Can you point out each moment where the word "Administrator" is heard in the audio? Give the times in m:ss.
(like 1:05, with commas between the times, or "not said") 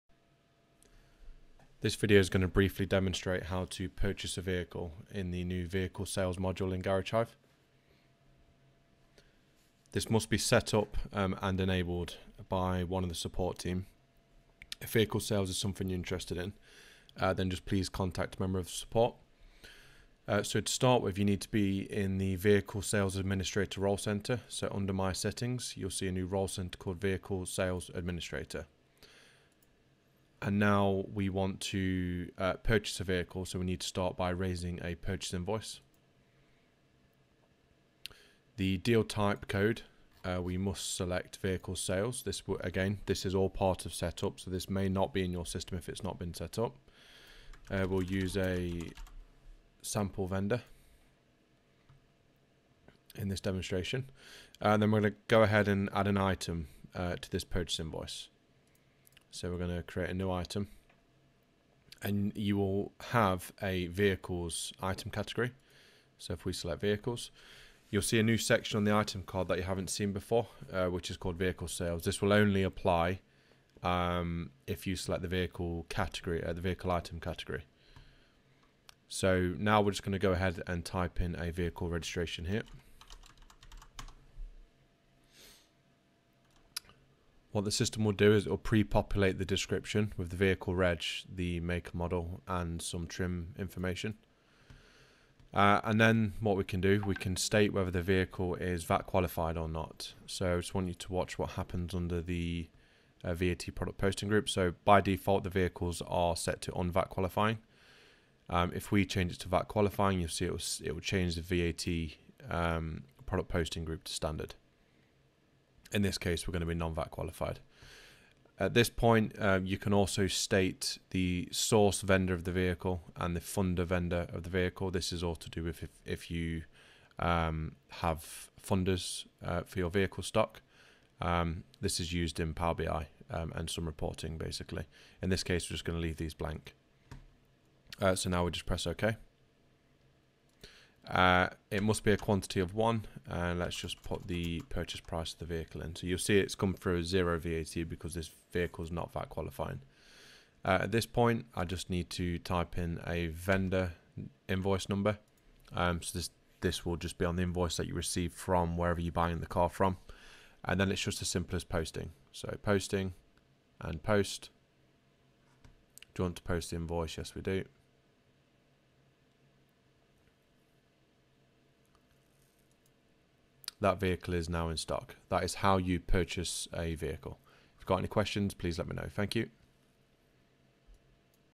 0:23, 0:27.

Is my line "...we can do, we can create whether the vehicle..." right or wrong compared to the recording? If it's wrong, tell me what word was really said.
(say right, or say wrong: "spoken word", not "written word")
wrong: "state", not "create".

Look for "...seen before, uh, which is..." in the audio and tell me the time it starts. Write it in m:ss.
1:09.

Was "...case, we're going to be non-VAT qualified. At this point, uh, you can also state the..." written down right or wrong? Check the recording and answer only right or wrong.
right.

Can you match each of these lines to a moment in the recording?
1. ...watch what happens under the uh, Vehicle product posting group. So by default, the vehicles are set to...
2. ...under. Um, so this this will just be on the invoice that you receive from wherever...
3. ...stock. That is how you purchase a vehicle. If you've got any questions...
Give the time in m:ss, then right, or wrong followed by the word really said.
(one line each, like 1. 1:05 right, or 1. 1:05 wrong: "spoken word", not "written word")
1. 1:41 wrong: "VAT", not "Vehicle"
2. 2:34 wrong: "number", not "under"
3. 2:54 right.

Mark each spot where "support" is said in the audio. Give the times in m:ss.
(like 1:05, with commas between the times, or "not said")
0:13, 0:18.